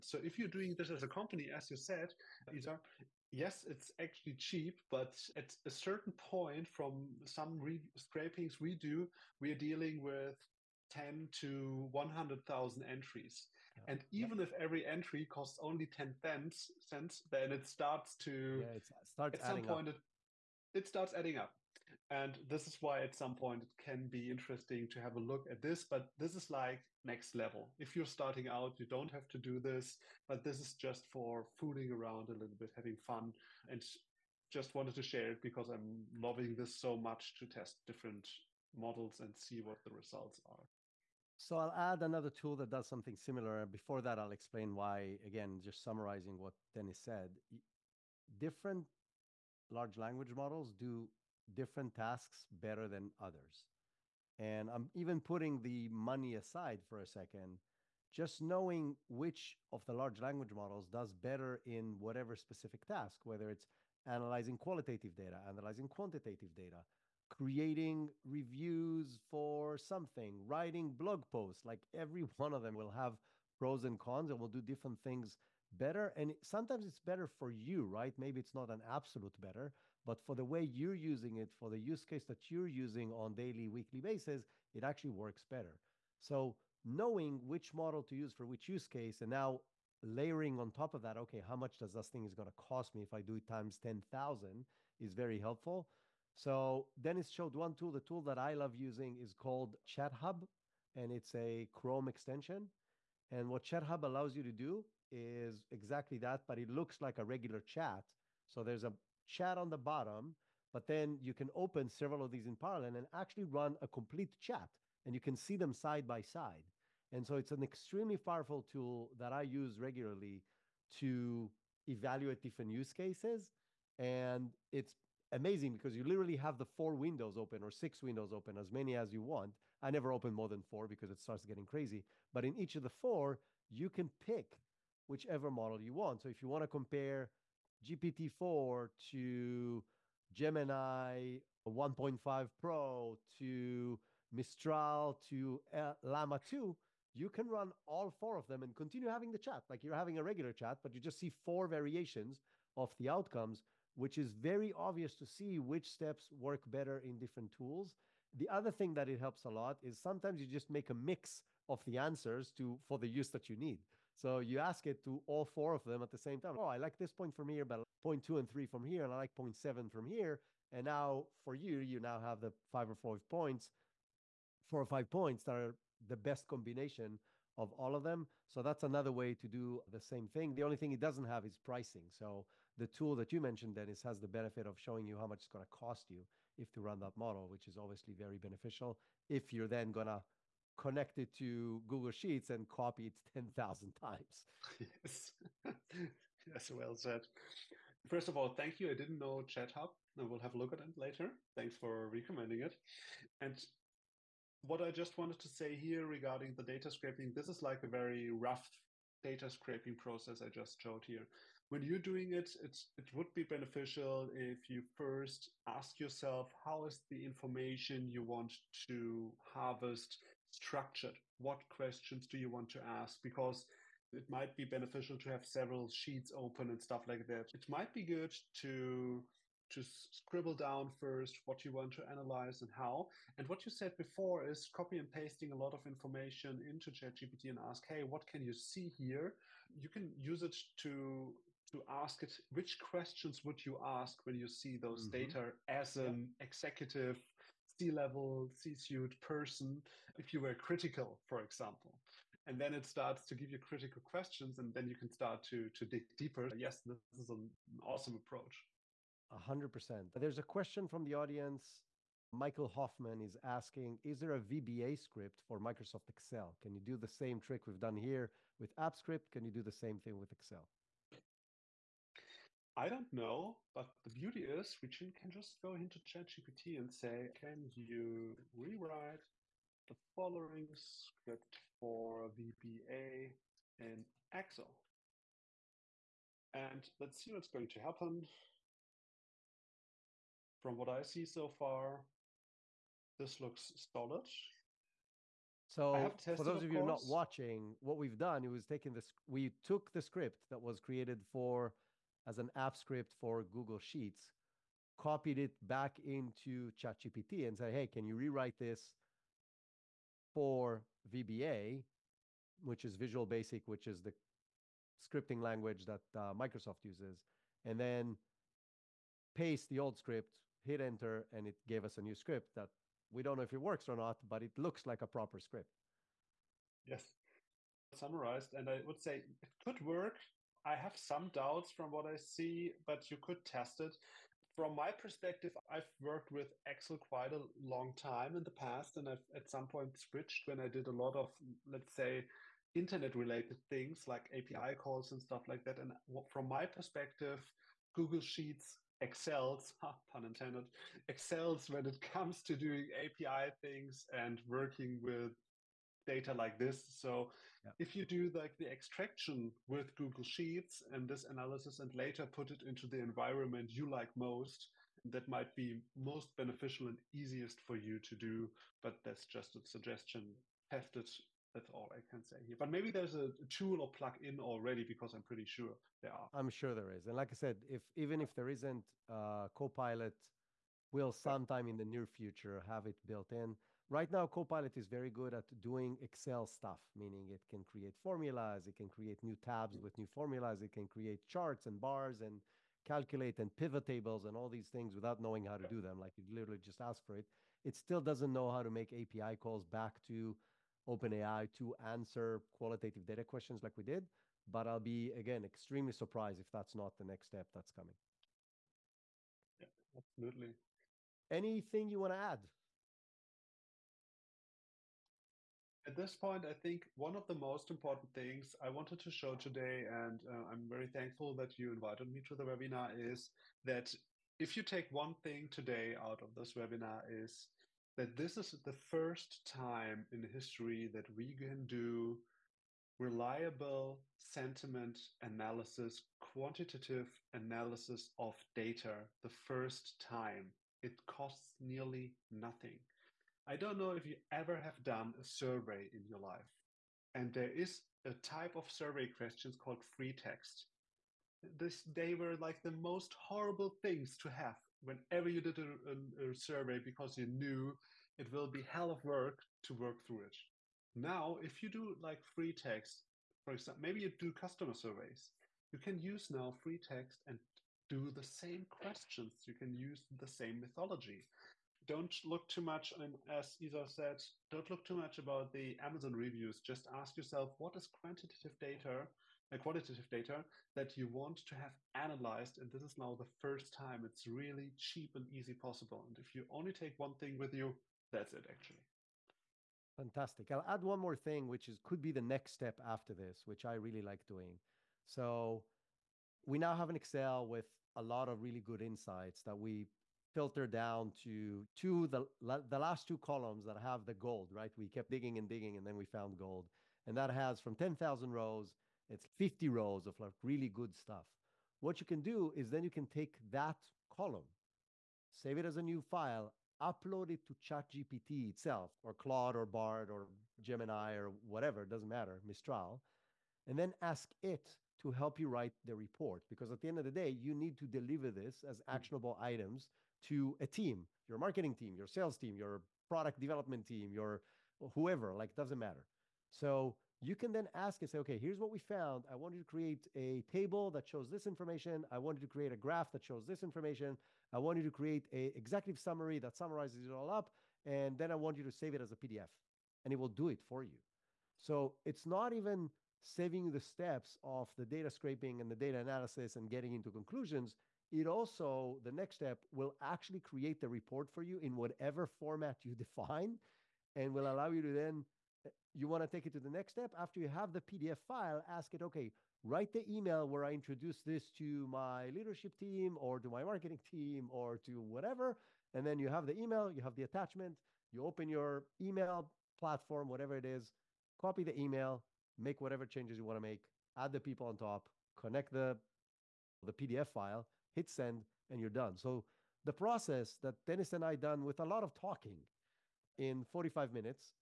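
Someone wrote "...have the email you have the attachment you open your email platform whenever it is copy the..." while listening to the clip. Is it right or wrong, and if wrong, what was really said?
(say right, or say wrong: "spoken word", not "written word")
wrong: "whatever", not "whenever".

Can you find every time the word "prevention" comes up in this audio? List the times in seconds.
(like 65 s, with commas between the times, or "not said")
not said.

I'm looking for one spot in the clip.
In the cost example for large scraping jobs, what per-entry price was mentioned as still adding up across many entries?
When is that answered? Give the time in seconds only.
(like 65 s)
15 s.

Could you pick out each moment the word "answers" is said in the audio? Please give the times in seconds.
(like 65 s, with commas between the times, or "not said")
161 s, 401 s.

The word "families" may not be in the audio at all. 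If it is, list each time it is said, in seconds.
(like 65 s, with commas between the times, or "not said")
not said.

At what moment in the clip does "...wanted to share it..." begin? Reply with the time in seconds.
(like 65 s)
34 s.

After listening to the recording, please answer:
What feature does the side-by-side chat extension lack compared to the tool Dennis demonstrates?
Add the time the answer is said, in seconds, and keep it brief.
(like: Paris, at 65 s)
Pricing, at 181 s.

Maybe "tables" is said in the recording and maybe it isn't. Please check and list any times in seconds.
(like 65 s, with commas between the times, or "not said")
393 s, 540 s.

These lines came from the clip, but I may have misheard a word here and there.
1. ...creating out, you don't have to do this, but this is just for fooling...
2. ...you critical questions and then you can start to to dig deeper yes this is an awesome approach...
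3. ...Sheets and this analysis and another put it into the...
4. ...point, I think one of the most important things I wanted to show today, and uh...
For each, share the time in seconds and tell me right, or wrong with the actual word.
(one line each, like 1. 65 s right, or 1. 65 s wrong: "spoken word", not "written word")
1. 28 s wrong: "starting", not "creating"
2. 253 s right
3. 360 s wrong: "later", not "another"
4. 416 s right.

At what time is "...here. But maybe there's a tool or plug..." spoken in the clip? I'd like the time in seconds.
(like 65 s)
372 s.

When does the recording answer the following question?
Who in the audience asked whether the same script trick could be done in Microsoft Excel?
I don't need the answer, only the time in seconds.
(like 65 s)
262 s.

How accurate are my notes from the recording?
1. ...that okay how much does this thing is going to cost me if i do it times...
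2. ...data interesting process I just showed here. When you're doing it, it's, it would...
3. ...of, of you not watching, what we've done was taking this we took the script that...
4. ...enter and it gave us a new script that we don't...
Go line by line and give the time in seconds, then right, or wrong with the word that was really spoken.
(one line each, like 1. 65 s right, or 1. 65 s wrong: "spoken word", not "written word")
1. 91 s right
2. 209 s wrong: "scraping", not "interesting"
3. 296 s right
4. 320 s right.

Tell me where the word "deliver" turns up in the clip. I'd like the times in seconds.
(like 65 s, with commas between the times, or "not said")
527 s.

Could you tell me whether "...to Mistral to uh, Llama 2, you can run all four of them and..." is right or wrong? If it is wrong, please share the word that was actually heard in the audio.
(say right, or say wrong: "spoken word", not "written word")
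right.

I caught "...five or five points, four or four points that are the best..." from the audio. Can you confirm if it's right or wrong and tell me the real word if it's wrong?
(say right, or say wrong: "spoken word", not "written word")
wrong: "five", not "four".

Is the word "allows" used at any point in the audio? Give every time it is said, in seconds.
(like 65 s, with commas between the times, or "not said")
104 s, 564 s.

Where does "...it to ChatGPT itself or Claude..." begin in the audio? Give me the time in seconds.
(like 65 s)
517 s.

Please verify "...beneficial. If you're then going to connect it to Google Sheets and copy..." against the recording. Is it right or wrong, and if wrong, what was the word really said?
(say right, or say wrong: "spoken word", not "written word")
right.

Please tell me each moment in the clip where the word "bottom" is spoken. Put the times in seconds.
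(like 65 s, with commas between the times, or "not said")
109 s.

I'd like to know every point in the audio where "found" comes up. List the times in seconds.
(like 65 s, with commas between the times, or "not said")
506 s, 538 s.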